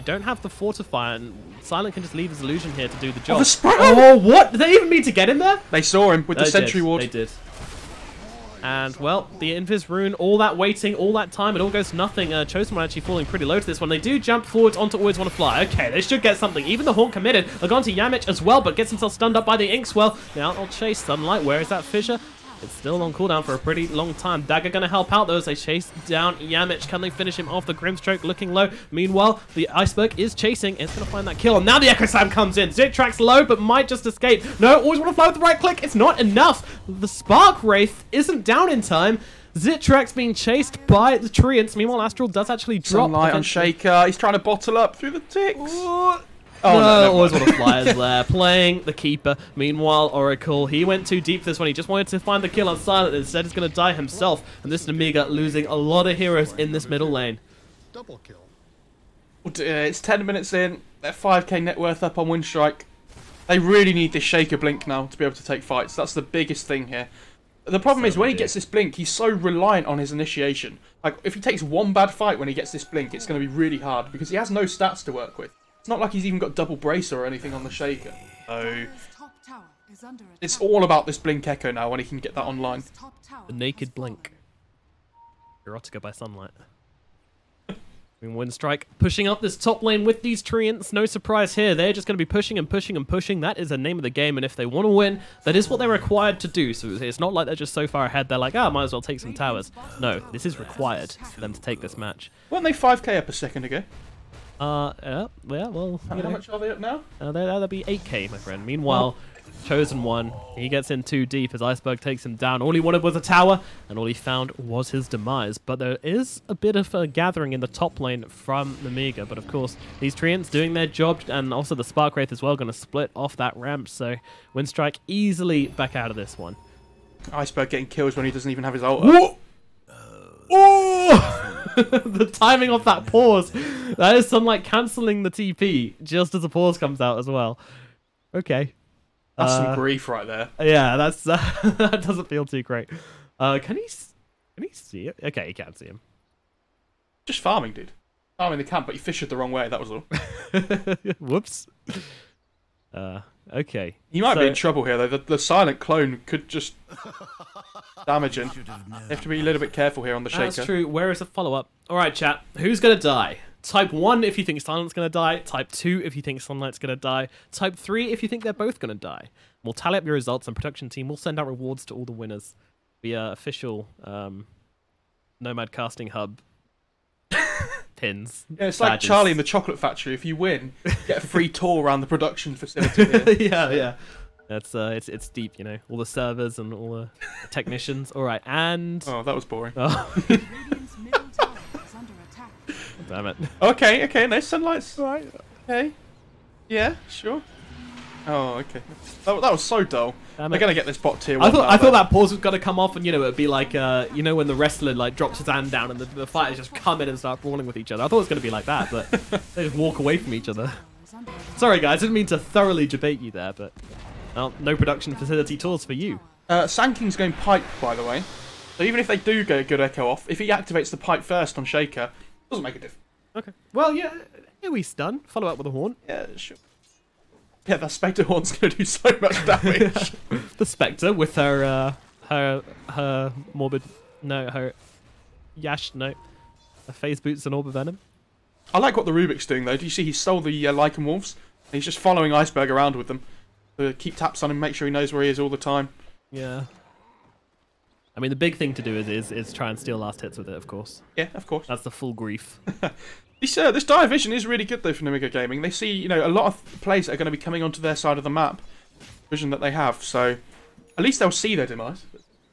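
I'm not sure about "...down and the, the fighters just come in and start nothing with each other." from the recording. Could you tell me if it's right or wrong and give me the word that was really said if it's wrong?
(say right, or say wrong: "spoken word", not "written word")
wrong: "brawling", not "nothing".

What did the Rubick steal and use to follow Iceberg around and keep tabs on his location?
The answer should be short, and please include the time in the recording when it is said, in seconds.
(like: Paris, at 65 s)
Lycan Wolves, at 240 s.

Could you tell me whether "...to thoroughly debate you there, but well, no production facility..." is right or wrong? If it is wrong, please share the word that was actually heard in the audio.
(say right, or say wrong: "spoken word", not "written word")
right.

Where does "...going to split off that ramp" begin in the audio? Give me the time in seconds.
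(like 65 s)
122 s.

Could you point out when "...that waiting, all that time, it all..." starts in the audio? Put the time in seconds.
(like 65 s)
10 s.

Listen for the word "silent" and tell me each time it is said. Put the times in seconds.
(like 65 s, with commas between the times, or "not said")
1 s, 52 s, 155 s, 164 s.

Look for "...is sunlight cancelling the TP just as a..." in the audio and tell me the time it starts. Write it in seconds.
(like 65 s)
134 s.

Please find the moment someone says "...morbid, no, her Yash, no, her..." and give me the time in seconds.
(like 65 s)
233 s.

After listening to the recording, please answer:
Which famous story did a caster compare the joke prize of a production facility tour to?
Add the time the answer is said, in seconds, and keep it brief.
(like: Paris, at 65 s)
Charlie in the Chocolate Factory, at 178 s.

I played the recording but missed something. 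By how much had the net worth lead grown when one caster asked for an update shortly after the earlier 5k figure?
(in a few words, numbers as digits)
8k.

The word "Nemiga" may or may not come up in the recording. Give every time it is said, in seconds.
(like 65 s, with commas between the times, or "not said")
118 s, 255 s.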